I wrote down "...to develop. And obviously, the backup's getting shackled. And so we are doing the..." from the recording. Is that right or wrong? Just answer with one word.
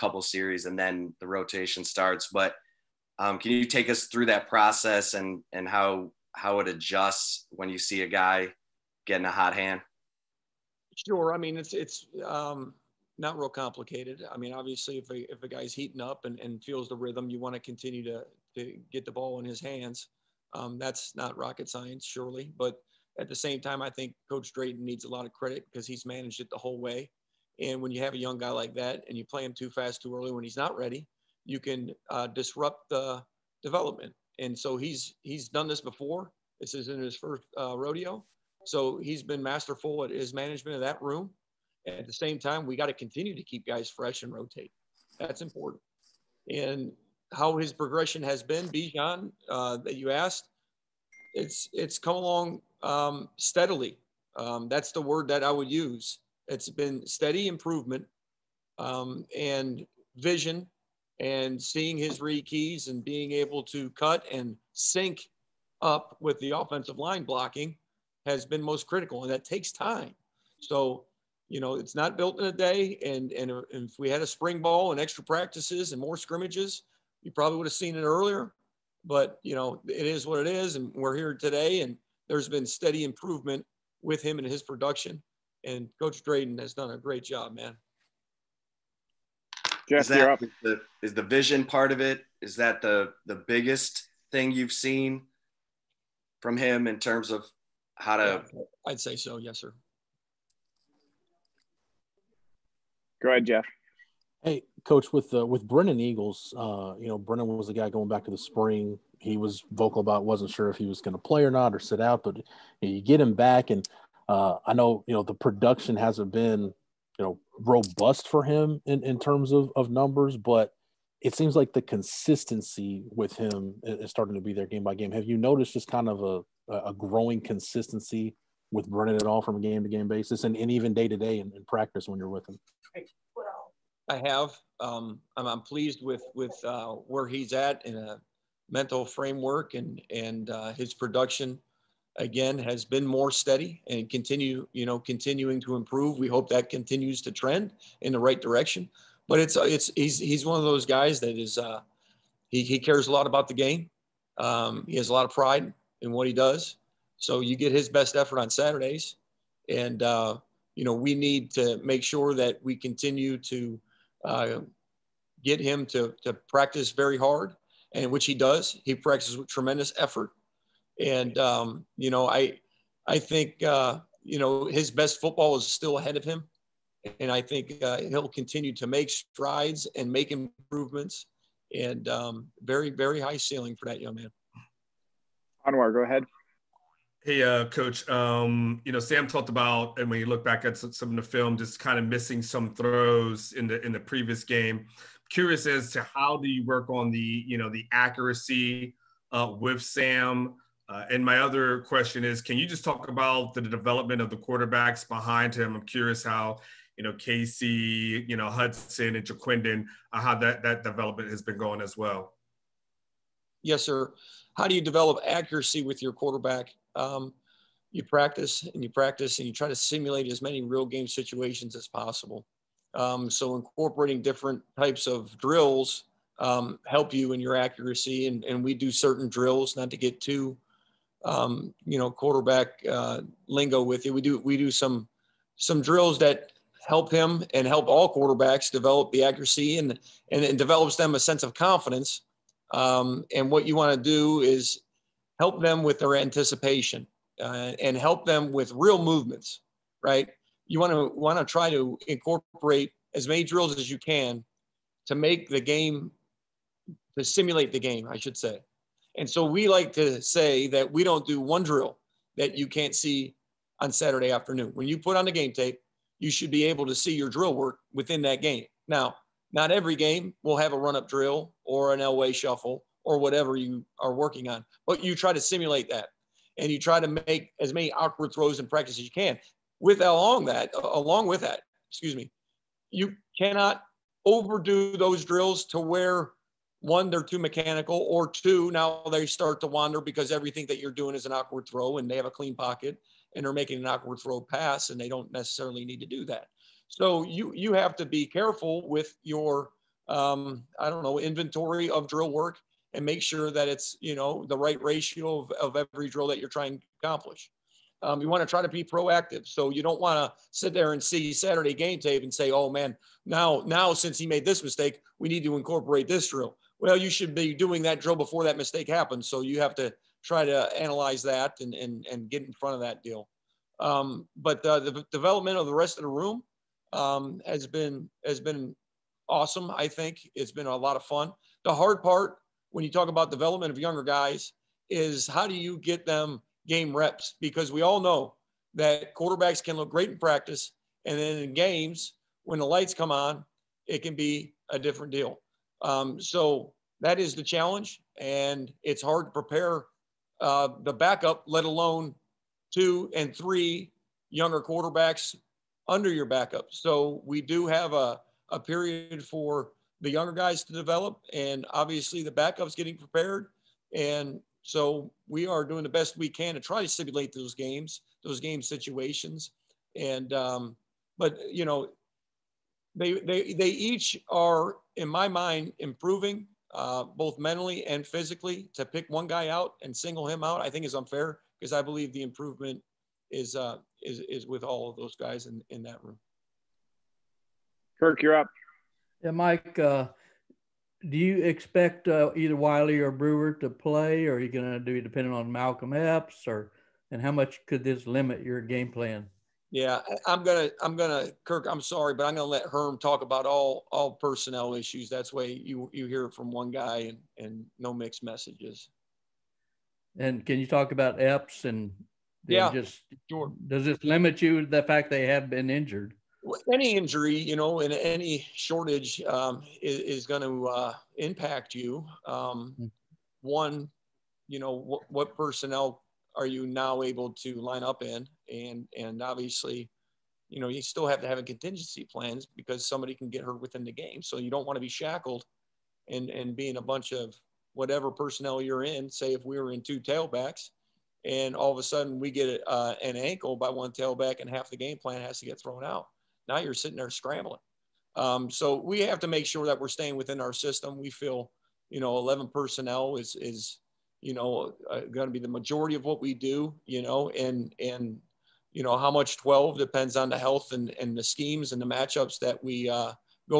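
wrong.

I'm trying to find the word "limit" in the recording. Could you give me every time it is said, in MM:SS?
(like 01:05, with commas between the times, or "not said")
06:38, 06:54.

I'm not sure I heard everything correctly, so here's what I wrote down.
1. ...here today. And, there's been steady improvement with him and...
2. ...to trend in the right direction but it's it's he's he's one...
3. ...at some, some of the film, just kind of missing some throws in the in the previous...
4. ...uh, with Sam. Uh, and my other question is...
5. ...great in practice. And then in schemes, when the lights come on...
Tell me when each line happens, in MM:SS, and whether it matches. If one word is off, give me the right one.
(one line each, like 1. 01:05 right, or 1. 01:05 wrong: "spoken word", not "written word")
1. 01:21 right
2. 02:27 right
3. 03:10 right
4. 03:19 right
5. 05:39 wrong: "games", not "schemes".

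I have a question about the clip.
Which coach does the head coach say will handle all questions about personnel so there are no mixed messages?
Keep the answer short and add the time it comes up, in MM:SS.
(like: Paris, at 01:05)
Herm, at 06:42.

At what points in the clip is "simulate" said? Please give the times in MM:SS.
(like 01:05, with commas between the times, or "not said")
03:39, 04:17, 04:35, 06:06.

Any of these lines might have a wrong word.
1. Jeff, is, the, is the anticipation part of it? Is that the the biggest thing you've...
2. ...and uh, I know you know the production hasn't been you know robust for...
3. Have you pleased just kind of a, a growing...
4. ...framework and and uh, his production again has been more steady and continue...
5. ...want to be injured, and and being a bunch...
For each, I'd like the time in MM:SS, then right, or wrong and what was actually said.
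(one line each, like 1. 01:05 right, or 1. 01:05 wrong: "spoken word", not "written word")
1. 01:29 wrong: "vision", not "anticipation"
2. 01:53 right
3. 02:05 wrong: "noticed", not "pleased"
4. 02:19 right
5. 07:14 wrong: "shackled", not "injured".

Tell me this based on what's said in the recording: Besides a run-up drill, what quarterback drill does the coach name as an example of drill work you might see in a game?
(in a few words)
L-way shuffle.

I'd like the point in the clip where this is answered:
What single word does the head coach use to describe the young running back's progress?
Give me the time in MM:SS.
00:53.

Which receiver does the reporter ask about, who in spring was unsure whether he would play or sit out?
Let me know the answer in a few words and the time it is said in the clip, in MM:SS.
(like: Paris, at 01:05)
Brennan Eagles, at 01:45.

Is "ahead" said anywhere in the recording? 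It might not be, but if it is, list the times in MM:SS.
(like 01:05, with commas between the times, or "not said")
01:43, 02:55, 03:06.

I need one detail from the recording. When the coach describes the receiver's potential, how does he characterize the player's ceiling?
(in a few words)
very very high.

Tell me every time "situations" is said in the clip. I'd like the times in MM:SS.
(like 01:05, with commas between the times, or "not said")
03:41, 06:08.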